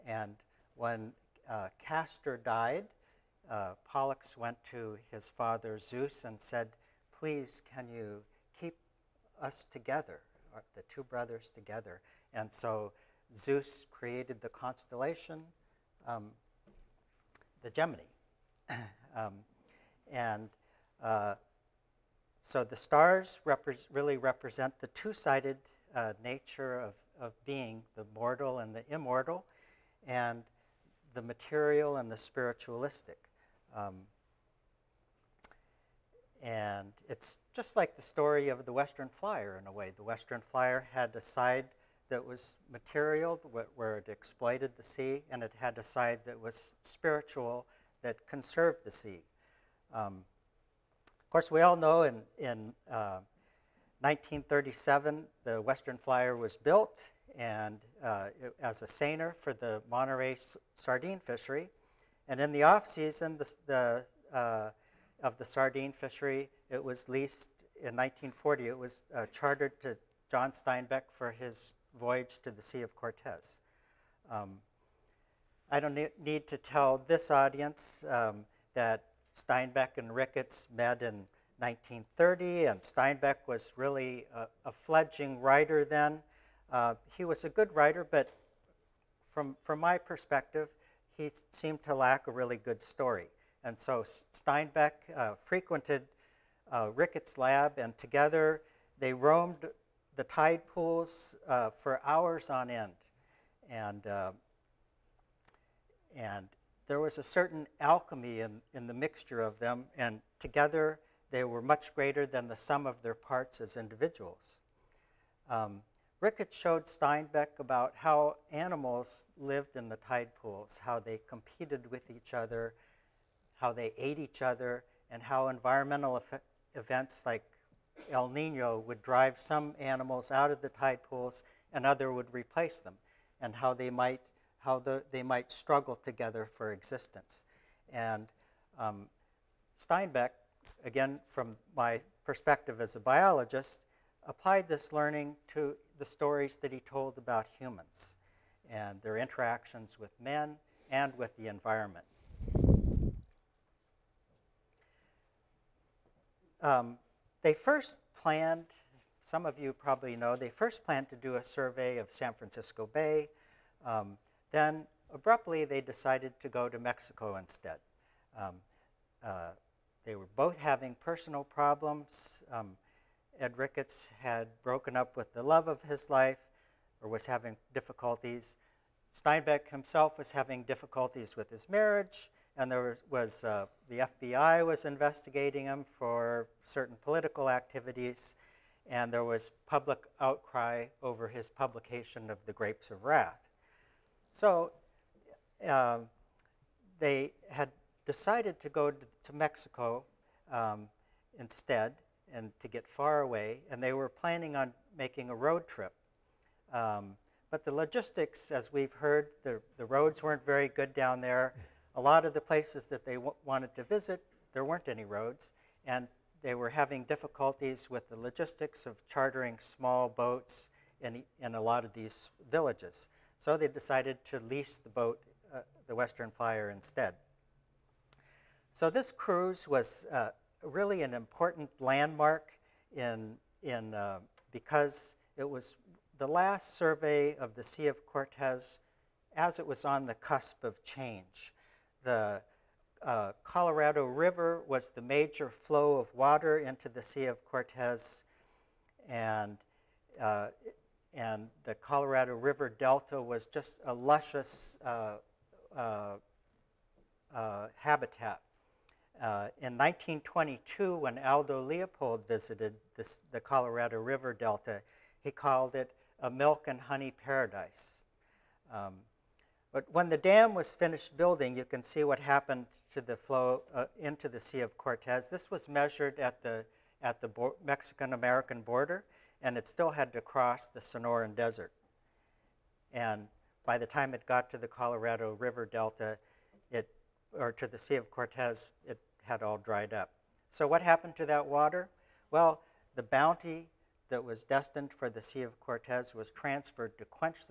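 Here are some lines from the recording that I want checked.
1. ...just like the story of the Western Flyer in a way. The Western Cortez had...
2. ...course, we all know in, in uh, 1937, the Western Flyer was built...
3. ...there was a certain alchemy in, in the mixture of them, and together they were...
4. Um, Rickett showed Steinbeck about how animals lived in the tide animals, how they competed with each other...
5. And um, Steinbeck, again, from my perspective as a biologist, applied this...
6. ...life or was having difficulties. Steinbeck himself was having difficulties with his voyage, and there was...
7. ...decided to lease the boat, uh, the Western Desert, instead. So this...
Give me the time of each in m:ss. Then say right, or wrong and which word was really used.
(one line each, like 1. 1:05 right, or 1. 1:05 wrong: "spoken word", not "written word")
1. 0:37 wrong: "Flyer", not "Cortez"
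2. 0:51 right
3. 1:46 right
4. 1:55 wrong: "pools", not "animals"
5. 2:17 right
6. 2:56 wrong: "marriage", not "voyage"
7. 3:43 wrong: "Flyer", not "Desert".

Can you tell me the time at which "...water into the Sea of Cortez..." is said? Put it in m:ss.
4:06.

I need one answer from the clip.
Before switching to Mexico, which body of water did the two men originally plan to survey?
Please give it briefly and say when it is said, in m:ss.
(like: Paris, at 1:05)
San Francisco Bay, at 2:42.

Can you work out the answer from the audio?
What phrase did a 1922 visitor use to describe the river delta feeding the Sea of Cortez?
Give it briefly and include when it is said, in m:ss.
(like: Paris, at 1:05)
milk and honey paradise, at 4:26.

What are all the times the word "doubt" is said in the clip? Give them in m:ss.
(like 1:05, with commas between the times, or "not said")
not said.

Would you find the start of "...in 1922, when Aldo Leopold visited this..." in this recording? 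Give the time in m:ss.
4:19.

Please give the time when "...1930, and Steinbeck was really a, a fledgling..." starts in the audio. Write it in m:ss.
1:21.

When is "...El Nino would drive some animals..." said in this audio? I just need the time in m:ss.
2:08.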